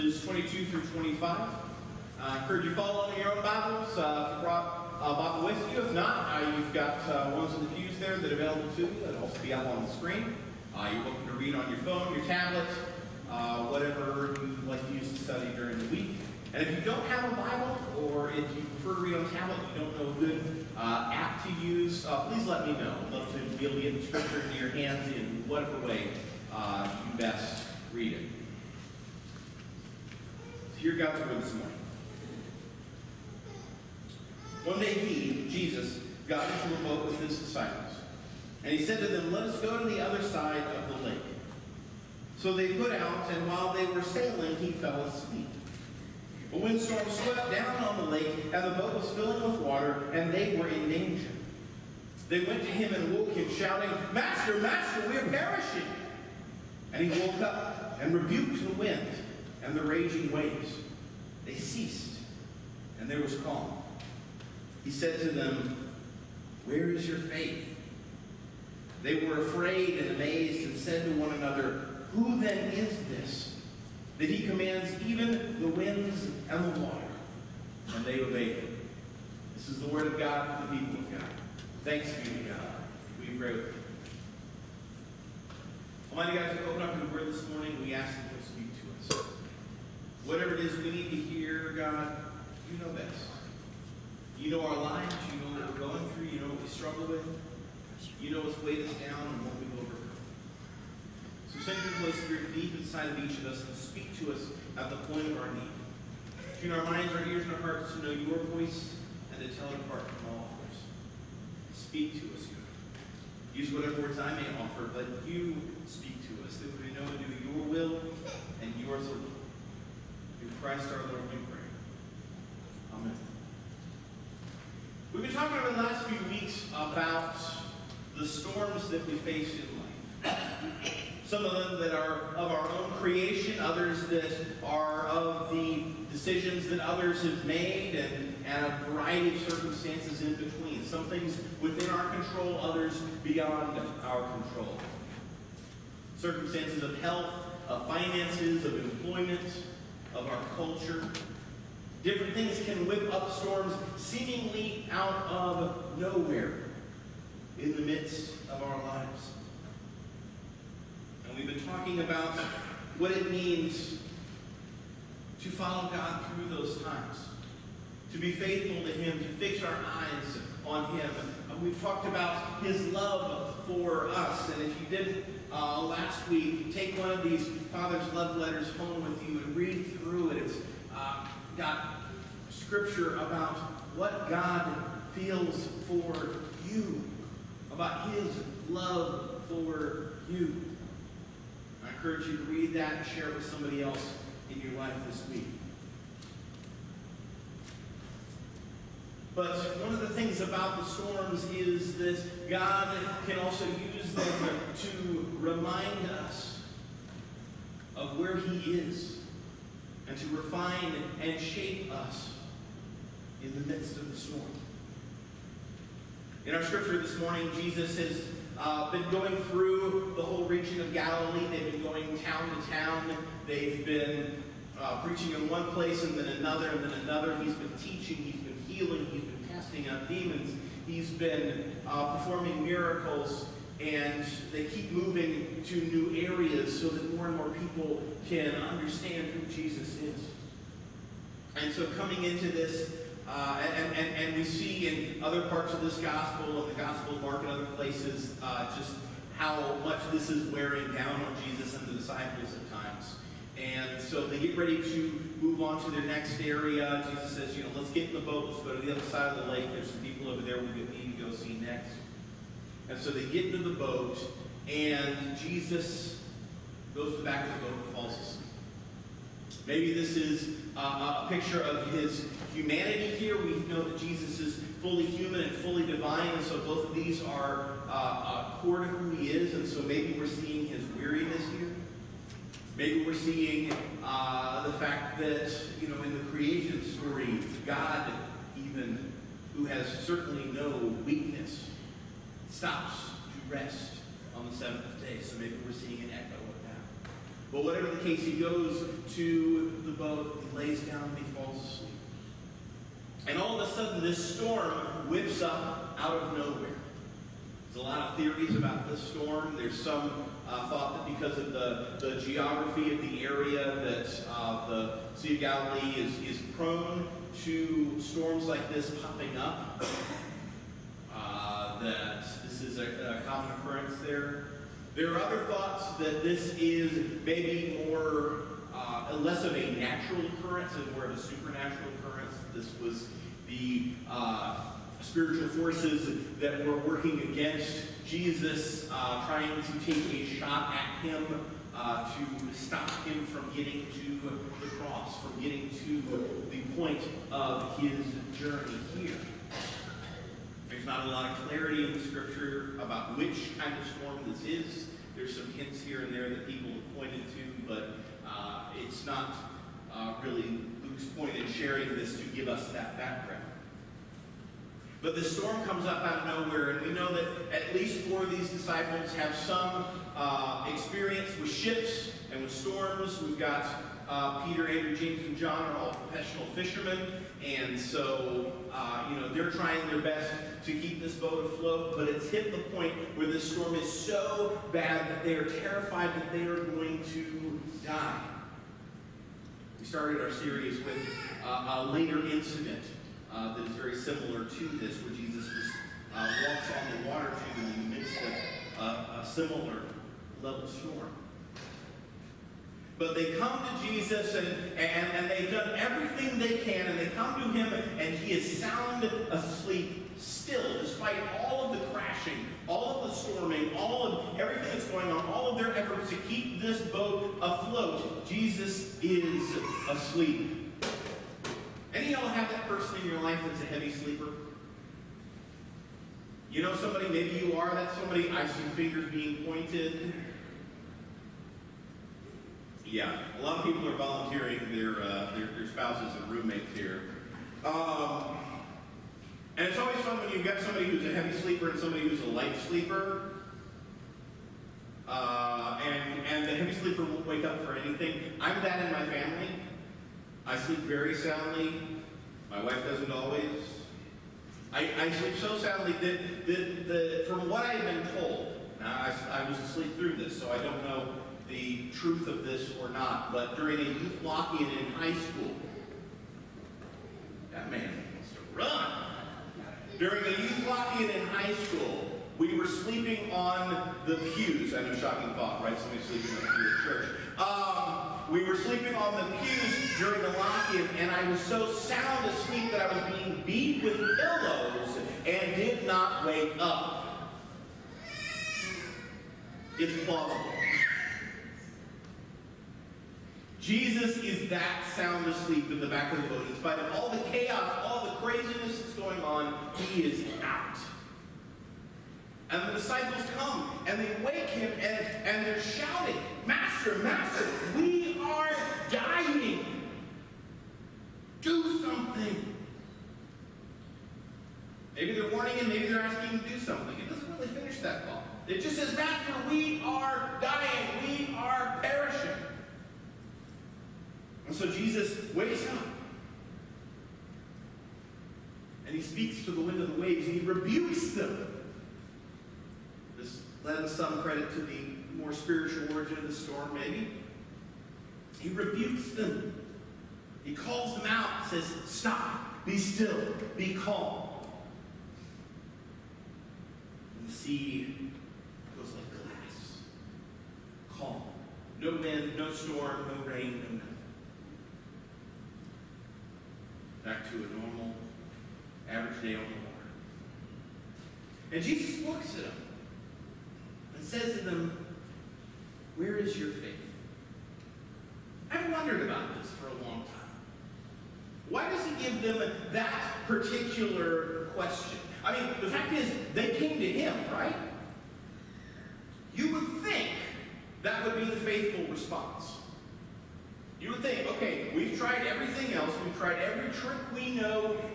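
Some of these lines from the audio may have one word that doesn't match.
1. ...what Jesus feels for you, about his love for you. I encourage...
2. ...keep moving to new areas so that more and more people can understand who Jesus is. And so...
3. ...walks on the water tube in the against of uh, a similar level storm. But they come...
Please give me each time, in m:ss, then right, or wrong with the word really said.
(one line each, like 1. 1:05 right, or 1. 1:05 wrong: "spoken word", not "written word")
1. 3:03 wrong: "God", not "Jesus"
2. 3:54 right
3. 6:36 wrong: "midst", not "against".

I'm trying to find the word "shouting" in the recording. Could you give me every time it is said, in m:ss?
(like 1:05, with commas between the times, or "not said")
0:53, 8:25.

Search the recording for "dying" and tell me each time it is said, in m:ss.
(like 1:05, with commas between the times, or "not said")
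8:28, 8:40.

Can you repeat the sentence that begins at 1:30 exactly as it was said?
Whatever it is we need to hear, God, you know best.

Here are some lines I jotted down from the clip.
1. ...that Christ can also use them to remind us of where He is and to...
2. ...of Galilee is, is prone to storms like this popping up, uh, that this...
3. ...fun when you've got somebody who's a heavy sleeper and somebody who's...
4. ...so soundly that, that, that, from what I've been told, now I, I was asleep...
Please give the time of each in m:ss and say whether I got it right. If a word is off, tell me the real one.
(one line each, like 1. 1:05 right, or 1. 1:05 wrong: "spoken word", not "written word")
1. 3:21 wrong: "God", not "Christ"
2. 5:15 right
3. 7:19 right
4. 7:35 right.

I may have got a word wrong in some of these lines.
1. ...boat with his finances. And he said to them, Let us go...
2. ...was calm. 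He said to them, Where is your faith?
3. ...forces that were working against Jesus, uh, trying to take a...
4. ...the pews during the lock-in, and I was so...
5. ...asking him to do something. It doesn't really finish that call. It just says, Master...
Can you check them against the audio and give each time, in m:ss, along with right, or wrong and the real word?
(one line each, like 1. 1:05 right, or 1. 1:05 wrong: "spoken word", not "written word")
1. 0:36 wrong: "disciples", not "finances"
2. 1:03 right
3. 5:35 right
4. 7:59 right
5. 8:35 right.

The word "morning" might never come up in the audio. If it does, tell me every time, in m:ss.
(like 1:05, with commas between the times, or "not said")
0:31, 1:27, 3:37.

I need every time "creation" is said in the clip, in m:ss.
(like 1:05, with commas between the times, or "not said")
2:12, 4:46.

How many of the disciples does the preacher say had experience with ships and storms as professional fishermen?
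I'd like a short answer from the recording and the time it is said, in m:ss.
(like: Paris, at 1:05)
4, at 6:08.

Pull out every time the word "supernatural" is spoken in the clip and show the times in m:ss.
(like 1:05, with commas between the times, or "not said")
5:31.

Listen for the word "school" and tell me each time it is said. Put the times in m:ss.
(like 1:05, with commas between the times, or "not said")
7:45, 7:51.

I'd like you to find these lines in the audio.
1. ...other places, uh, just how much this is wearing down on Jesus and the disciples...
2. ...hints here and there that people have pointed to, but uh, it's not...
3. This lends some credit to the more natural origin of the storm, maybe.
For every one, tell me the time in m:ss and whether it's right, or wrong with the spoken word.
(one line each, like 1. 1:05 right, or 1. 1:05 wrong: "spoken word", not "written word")
1. 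4:07 right
2. 5:55 right
3. 8:53 wrong: "spiritual", not "natural".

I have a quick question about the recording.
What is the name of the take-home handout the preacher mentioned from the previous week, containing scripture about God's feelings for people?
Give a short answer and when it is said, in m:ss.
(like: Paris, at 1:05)
Father's Love Letters, at 2:57.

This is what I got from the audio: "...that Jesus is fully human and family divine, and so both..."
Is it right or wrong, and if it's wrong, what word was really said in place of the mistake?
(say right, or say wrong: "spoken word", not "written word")
wrong: "fully", not "family".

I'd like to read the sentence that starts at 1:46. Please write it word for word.
Tune our minds, our ears, and our hearts to know your voice and to tell it apart from all others.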